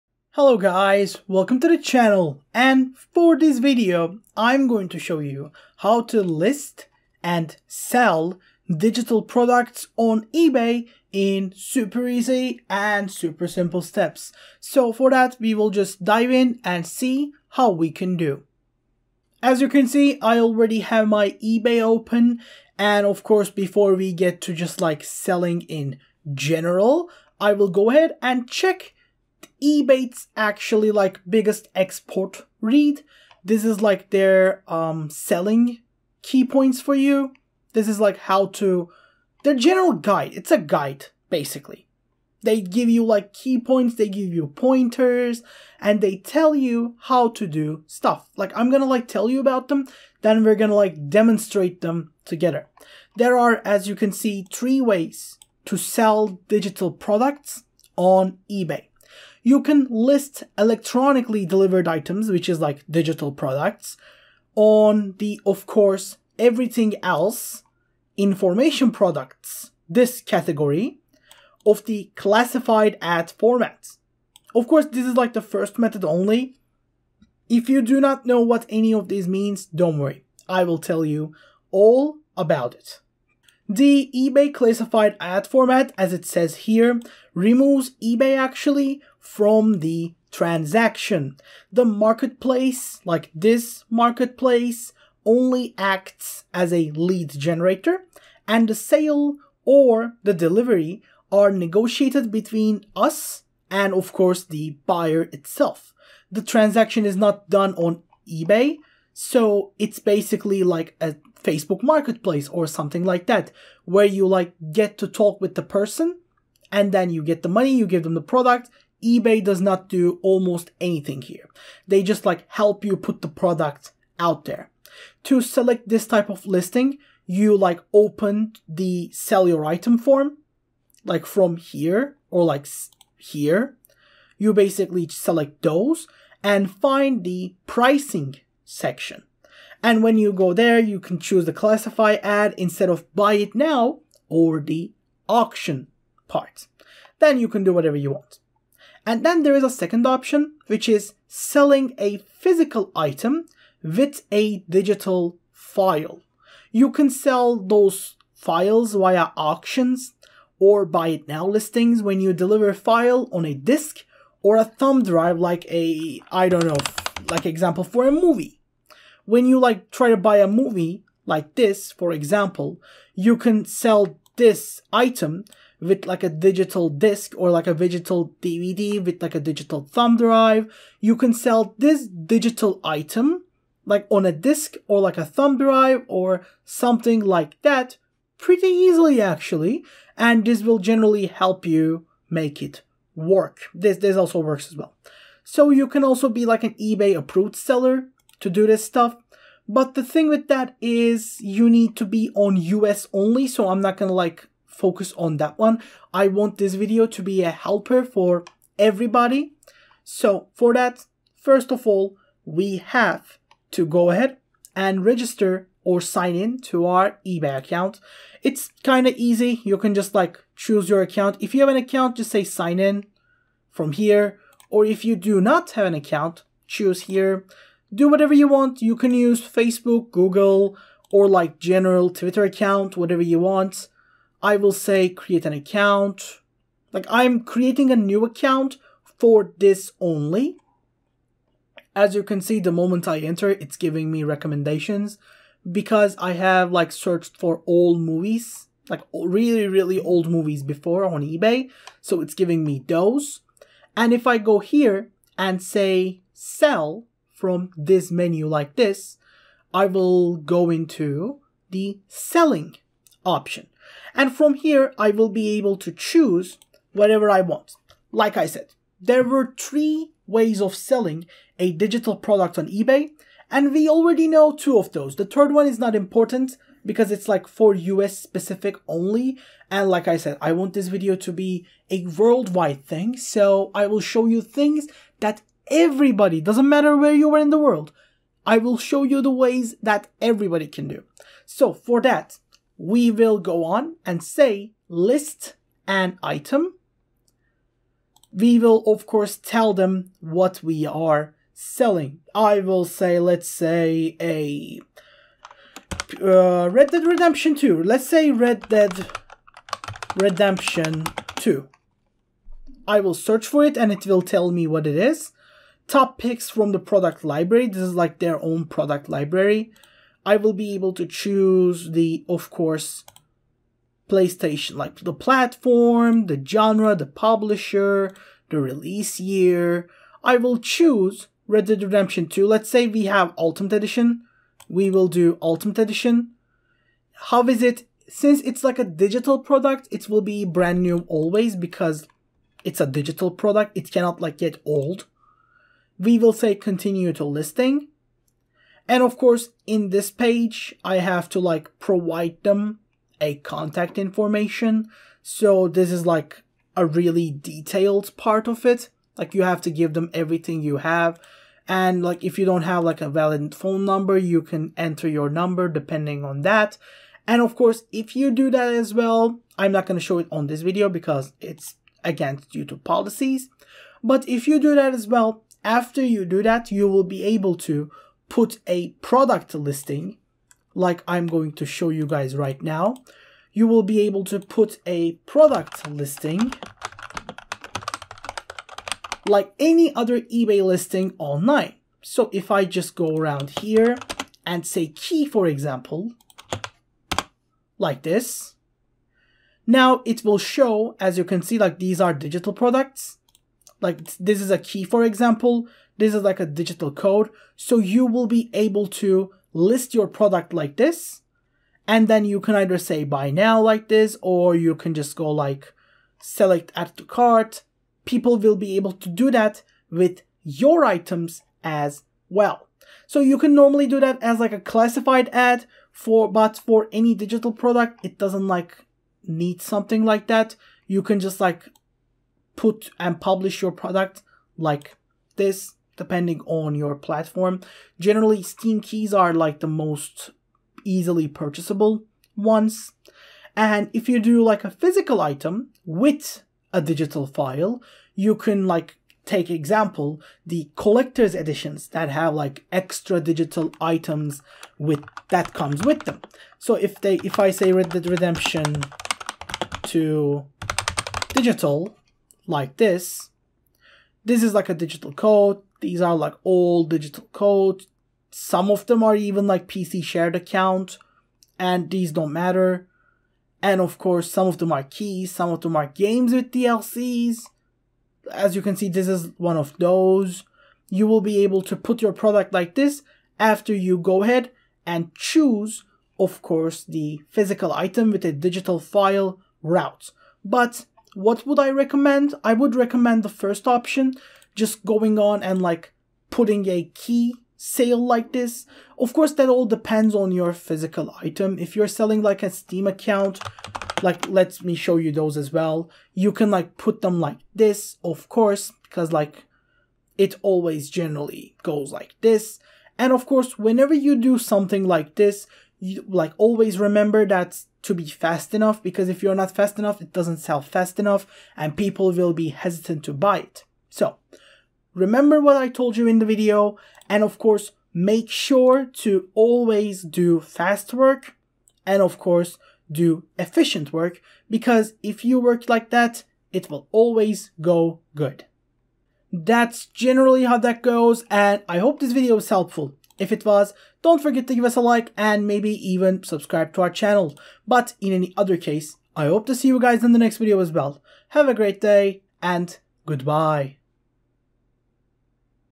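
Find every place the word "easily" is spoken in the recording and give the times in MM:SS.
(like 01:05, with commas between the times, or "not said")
03:08, 07:20.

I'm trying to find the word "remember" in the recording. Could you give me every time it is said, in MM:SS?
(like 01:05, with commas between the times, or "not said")
08:36, 08:44.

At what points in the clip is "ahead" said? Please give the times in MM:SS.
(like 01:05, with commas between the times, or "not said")
00:27, 03:34, 08:04.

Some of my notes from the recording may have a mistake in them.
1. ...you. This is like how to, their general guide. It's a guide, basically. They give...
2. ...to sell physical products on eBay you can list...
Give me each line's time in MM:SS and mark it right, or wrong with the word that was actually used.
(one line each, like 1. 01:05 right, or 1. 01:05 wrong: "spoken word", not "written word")
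1. 00:36 right
2. 00:55 wrong: "digital", not "physical".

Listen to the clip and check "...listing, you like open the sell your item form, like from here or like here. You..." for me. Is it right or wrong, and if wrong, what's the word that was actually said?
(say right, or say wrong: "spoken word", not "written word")
right.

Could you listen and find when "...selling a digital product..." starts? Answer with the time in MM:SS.
04:30.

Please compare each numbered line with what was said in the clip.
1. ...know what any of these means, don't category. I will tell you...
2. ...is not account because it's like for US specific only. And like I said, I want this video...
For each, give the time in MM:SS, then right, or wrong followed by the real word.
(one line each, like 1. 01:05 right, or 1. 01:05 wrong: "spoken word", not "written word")
1. 01:18 wrong: "worry", not "category"
2. 04:35 wrong: "important", not "account".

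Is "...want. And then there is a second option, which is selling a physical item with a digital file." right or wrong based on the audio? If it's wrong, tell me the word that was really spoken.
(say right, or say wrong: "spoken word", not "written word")
right.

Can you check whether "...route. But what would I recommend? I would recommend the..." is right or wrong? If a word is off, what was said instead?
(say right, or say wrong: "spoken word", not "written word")
right.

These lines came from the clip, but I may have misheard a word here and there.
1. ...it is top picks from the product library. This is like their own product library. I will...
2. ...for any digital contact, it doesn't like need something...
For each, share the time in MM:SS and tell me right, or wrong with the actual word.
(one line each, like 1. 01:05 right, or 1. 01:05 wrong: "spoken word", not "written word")
1. 05:14 right
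2. 07:06 wrong: "product", not "contact".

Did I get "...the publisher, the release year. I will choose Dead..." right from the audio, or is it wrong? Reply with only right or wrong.
wrong.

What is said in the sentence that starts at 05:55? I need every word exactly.
So this is like a really detailed part of it.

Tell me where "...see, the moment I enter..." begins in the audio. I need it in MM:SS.
04:02.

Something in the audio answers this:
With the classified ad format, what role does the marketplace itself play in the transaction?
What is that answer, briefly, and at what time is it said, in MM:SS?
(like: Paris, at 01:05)
Lead generator, at 01:36.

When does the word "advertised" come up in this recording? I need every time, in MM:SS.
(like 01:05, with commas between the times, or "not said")
not said.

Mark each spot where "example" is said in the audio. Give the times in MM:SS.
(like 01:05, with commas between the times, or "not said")
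02:47, 02:52, 06:35, 06:45, 07:29.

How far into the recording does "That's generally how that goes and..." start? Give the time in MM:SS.
08:59.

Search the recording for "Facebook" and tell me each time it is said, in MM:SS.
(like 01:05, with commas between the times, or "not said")
01:51, 03:49.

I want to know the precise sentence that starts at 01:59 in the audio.
eBay does not do almost anything here.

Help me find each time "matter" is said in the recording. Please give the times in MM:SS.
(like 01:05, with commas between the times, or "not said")
04:46, 07:52.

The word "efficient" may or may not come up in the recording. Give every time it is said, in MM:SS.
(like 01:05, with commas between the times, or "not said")
08:53.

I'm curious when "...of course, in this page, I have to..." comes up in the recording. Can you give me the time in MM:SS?
05:49.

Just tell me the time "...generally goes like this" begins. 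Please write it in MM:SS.
08:30.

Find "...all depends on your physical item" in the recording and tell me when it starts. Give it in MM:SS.
08:19.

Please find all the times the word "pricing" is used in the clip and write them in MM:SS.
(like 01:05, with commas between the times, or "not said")
02:17.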